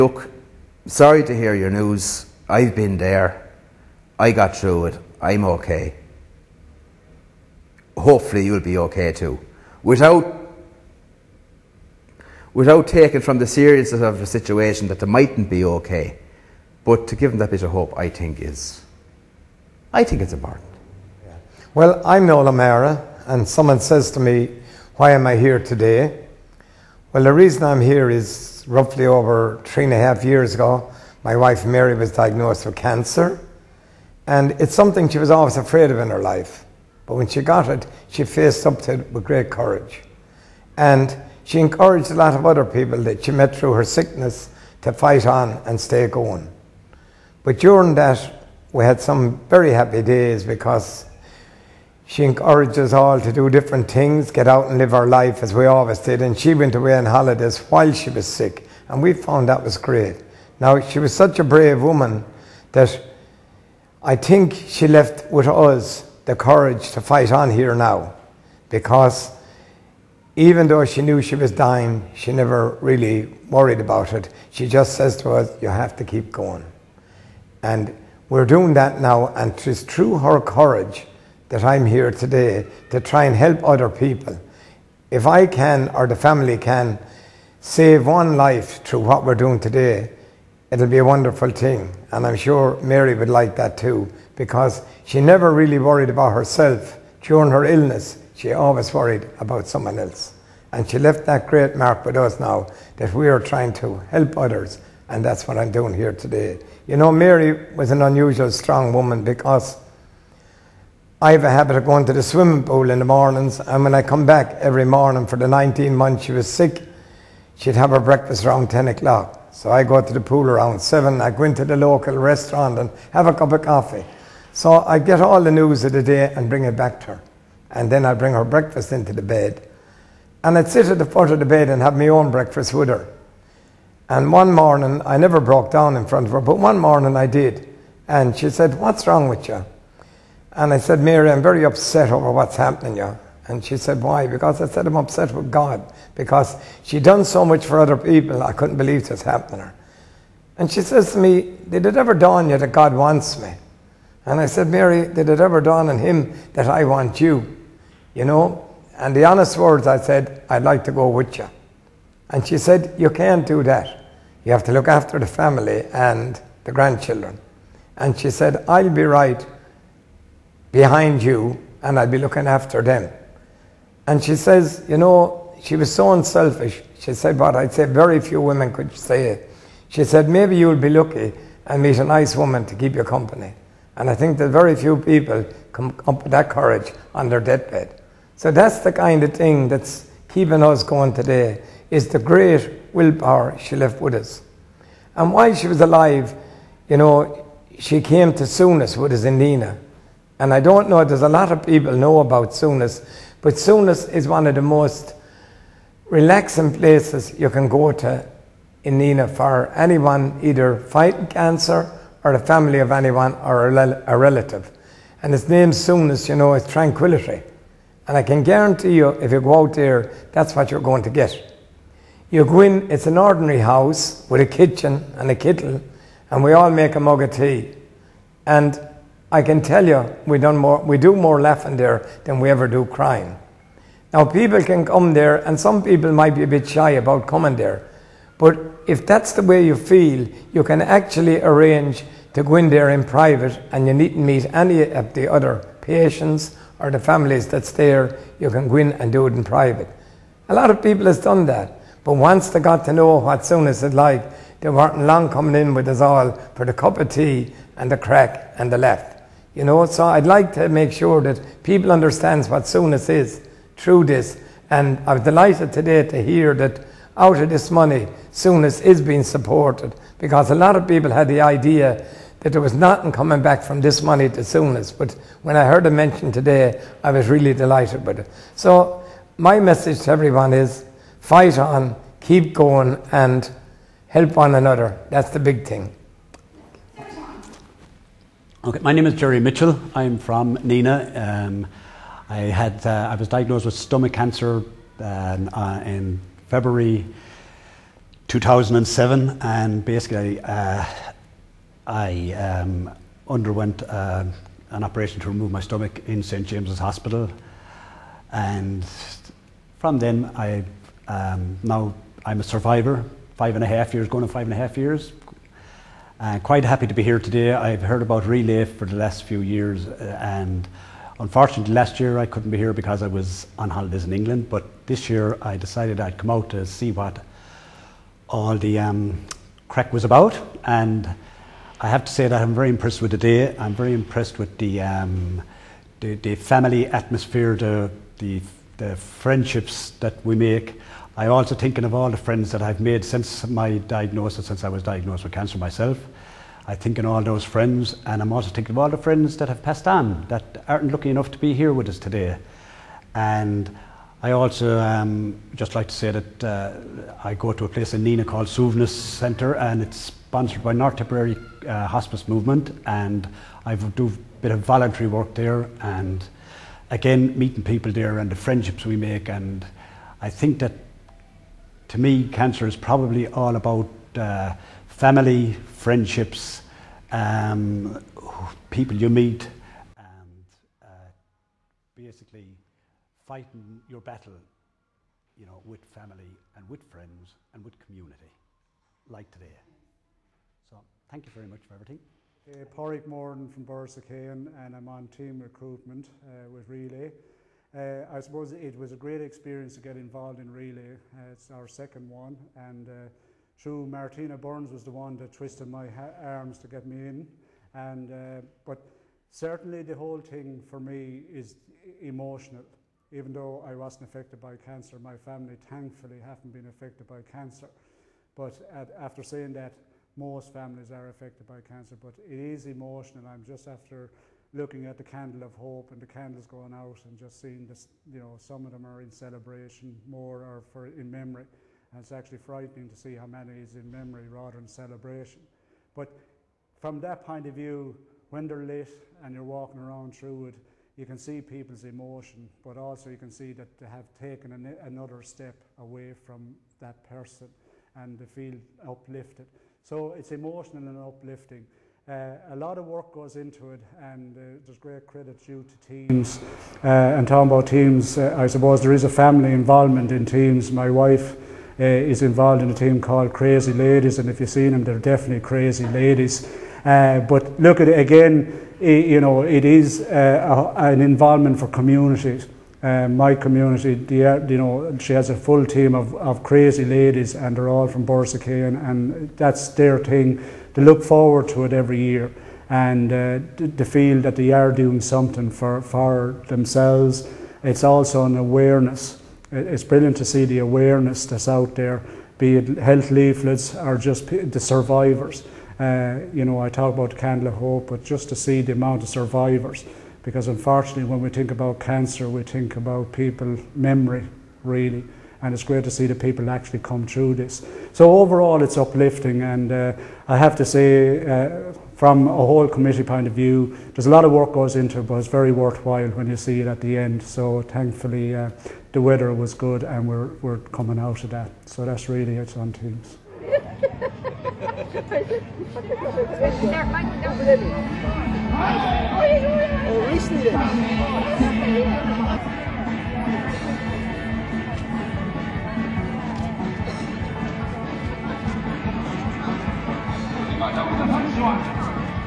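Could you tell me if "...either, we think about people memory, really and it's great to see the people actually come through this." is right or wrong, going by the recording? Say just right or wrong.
wrong.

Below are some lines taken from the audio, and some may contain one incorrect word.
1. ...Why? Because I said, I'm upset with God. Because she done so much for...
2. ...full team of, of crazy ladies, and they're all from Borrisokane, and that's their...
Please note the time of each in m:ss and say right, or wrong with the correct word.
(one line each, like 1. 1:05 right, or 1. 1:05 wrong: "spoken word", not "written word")
1. 2:24 right
2. 7:55 right.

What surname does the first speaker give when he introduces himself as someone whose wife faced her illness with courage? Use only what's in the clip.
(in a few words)
O'Mara.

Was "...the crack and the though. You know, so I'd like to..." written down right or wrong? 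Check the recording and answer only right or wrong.
wrong.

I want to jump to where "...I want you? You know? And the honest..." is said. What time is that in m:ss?
2:36.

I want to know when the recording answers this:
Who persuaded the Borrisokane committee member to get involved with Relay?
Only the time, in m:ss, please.
6:43.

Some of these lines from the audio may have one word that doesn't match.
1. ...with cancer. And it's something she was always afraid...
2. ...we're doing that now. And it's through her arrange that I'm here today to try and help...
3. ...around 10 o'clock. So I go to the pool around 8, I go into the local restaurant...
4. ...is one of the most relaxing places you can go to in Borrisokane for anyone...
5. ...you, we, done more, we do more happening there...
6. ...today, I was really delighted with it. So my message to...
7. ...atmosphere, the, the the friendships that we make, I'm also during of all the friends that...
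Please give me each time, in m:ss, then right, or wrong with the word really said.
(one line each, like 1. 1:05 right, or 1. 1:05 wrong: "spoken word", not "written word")
1. 0:32 right
2. 1:18 wrong: "courage", not "arrange"
3. 1:58 wrong: "7", not "8"
4. 3:24 wrong: "Nenagh", not "Borrisokane"
5. 3:49 wrong: "laughing", not "happening"
6. 4:36 right
7. 5:36 wrong: "thinking", not "during".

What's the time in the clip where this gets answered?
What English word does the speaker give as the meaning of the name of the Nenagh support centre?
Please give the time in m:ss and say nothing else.
3:36.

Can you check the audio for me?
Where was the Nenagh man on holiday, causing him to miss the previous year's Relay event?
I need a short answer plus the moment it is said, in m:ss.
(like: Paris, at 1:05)
England, at 5:24.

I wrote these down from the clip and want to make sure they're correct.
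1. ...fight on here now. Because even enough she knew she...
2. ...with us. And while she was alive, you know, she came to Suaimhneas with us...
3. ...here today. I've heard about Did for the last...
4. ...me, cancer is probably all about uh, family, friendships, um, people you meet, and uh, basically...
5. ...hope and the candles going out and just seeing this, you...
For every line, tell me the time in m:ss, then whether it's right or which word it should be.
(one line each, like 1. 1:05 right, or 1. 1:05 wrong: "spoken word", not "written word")
1. 1:06 wrong: "though", not "enough"
2. 3:14 right
3. 5:17 wrong: "Relay", not "Did"
4. 6:11 right
5. 7:05 right.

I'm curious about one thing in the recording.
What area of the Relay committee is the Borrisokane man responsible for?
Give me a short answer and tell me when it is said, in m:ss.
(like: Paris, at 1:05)
team recruitment, at 6:35.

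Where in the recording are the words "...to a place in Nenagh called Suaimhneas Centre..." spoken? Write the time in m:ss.
5:57.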